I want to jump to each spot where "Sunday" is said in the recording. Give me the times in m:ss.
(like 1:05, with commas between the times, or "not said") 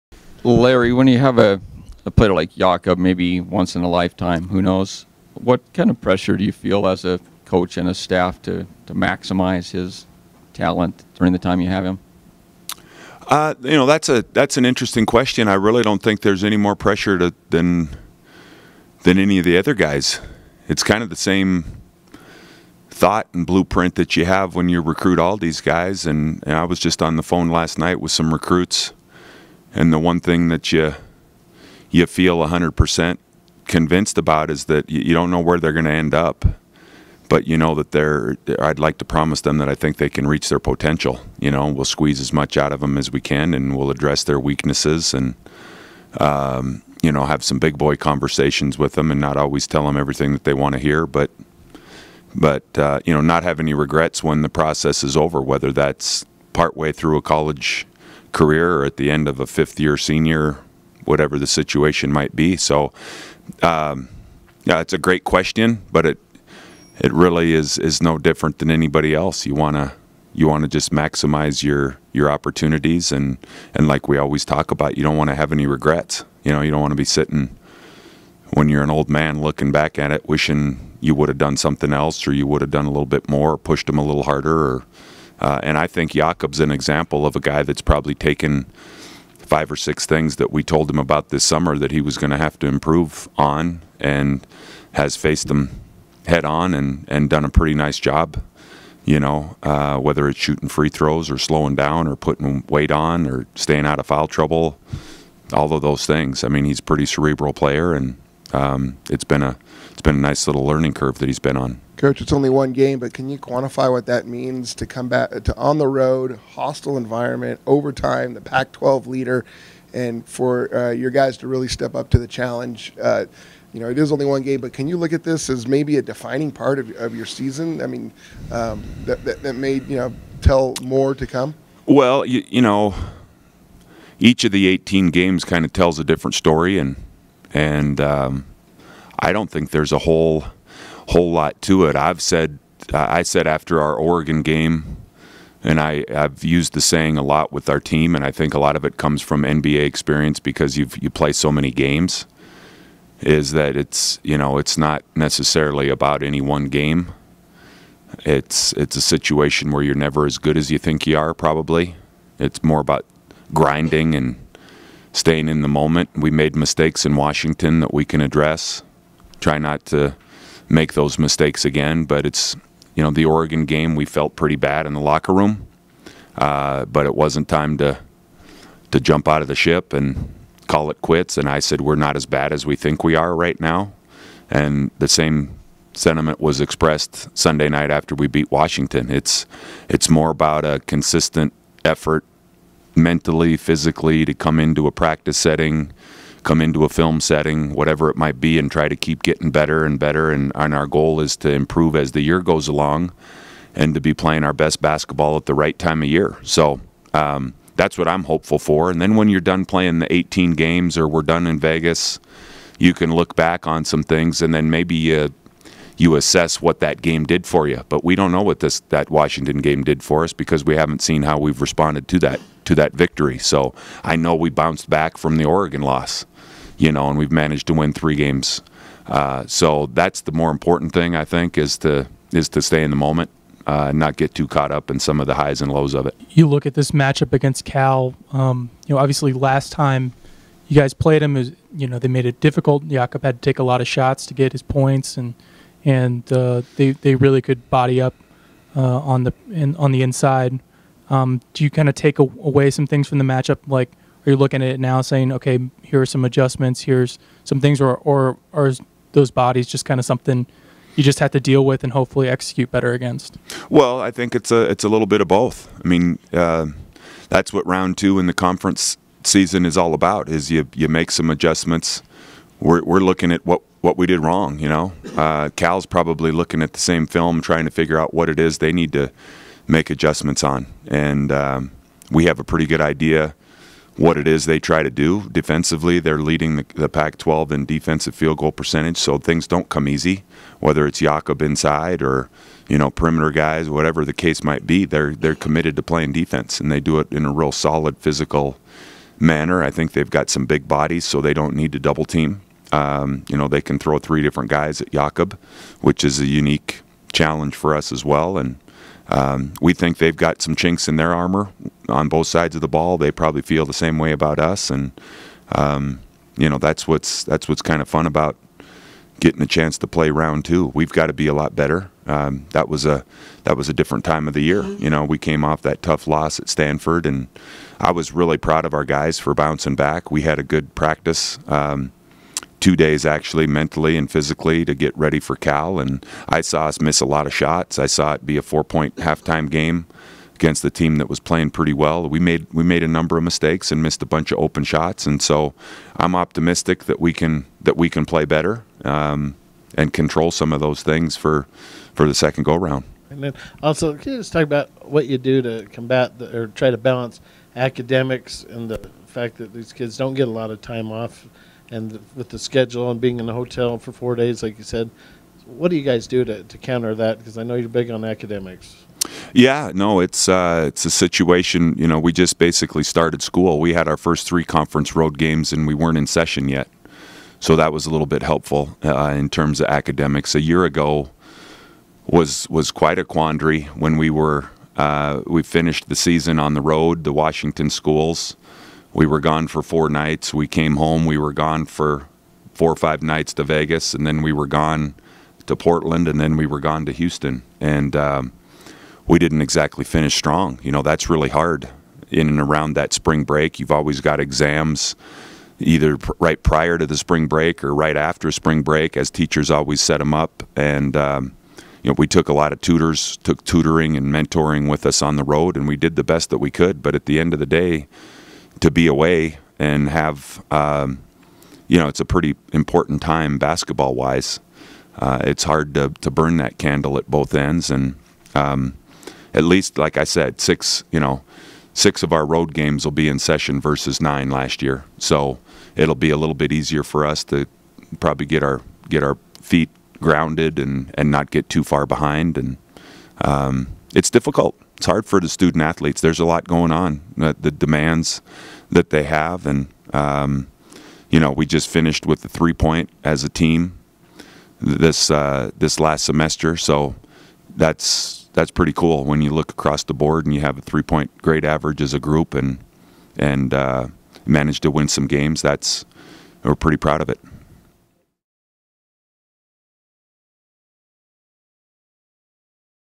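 3:07.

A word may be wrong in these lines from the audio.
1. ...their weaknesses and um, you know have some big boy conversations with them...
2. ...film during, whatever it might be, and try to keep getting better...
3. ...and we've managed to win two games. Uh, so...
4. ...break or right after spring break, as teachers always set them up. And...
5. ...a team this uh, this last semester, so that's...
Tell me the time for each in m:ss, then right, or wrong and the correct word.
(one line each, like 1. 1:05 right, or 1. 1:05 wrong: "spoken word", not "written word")
1. 0:44 right
2. 3:16 wrong: "setting", not "during"
3. 3:47 wrong: "three", not "two"
4. 6:47 right
5. 7:33 right.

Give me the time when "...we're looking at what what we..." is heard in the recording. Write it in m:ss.
4:32.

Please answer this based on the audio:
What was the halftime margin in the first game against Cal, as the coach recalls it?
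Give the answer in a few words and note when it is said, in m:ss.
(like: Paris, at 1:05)
4 points, at 5:38.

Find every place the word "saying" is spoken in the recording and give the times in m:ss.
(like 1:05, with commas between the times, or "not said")
2:26, 4:15.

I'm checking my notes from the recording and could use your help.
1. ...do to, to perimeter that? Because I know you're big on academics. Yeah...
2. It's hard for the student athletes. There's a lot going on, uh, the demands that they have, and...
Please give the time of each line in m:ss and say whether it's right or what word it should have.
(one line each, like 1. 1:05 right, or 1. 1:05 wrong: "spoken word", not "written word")
1. 6:06 wrong: "counter", not "perimeter"
2. 7:24 right.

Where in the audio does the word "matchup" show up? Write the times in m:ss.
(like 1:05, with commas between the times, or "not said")
3:56, 4:13.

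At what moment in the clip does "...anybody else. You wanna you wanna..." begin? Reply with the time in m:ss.
1:08.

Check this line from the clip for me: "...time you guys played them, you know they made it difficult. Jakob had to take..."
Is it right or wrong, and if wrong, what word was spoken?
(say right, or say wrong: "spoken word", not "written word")
right.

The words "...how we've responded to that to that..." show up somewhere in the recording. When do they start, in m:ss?
3:41.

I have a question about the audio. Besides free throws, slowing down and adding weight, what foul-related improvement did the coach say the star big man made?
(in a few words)
staying out of foul trouble.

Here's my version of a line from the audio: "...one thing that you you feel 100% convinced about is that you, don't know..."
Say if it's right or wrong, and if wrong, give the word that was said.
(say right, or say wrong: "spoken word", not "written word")
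right.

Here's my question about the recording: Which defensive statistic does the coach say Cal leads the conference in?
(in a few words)
defensive field goal percentage.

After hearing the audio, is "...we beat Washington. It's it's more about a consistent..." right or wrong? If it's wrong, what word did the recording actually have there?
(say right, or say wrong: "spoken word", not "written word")
right.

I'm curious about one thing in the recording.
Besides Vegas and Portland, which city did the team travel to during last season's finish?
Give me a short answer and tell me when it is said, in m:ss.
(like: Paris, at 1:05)
Houston, at 6:36.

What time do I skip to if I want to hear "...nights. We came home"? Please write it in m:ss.
6:29.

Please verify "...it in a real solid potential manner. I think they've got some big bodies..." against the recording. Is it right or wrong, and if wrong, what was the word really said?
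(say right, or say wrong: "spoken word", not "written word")
wrong: "physical", not "potential".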